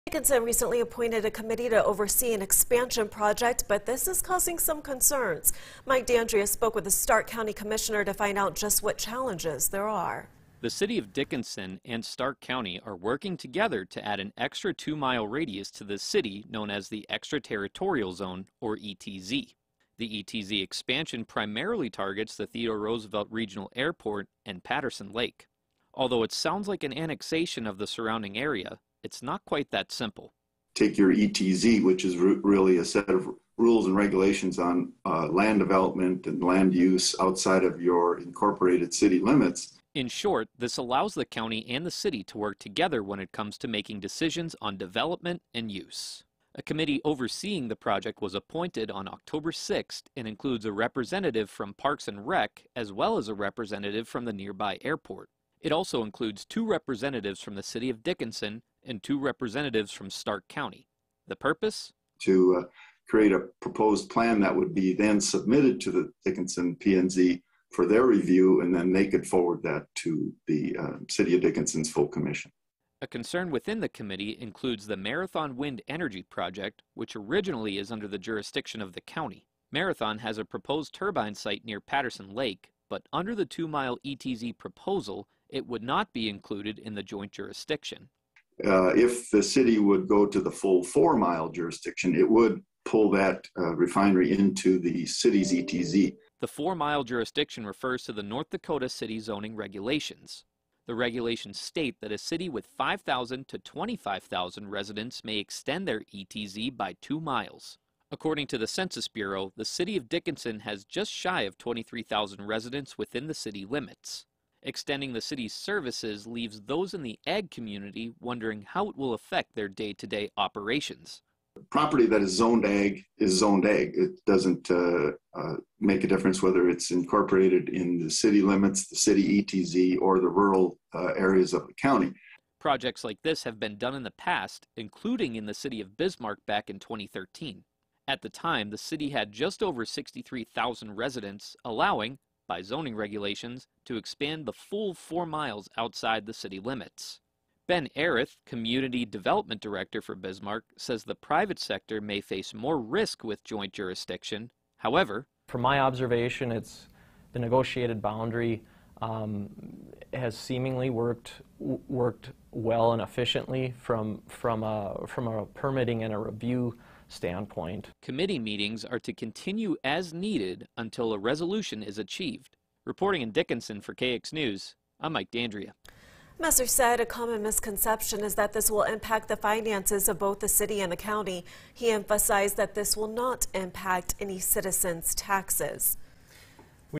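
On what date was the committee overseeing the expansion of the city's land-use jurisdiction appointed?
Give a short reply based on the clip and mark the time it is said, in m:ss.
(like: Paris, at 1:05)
October 6, at 0:49.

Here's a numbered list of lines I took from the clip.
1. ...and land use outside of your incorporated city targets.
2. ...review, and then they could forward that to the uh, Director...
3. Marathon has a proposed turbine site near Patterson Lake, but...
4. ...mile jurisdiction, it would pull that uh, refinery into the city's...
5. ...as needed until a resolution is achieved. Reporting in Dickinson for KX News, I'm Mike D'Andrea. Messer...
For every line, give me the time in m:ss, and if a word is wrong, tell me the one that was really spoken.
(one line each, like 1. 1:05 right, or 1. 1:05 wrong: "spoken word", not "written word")
1. 0:36 wrong: "limits", not "targets"
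2. 1:08 wrong: "City", not "Director"
3. 1:19 right
4. 1:31 right
5. 2:49 right.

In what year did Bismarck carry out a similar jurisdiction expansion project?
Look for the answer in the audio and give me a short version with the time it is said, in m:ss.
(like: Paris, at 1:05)
2013, at 2:16.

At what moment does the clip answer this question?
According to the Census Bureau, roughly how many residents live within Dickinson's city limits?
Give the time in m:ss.
1:51.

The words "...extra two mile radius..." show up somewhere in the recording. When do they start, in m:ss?
0:14.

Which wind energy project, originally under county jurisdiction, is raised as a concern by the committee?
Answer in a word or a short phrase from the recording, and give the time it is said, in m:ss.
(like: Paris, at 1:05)
Marathon Wind Energy Project, at 1:14.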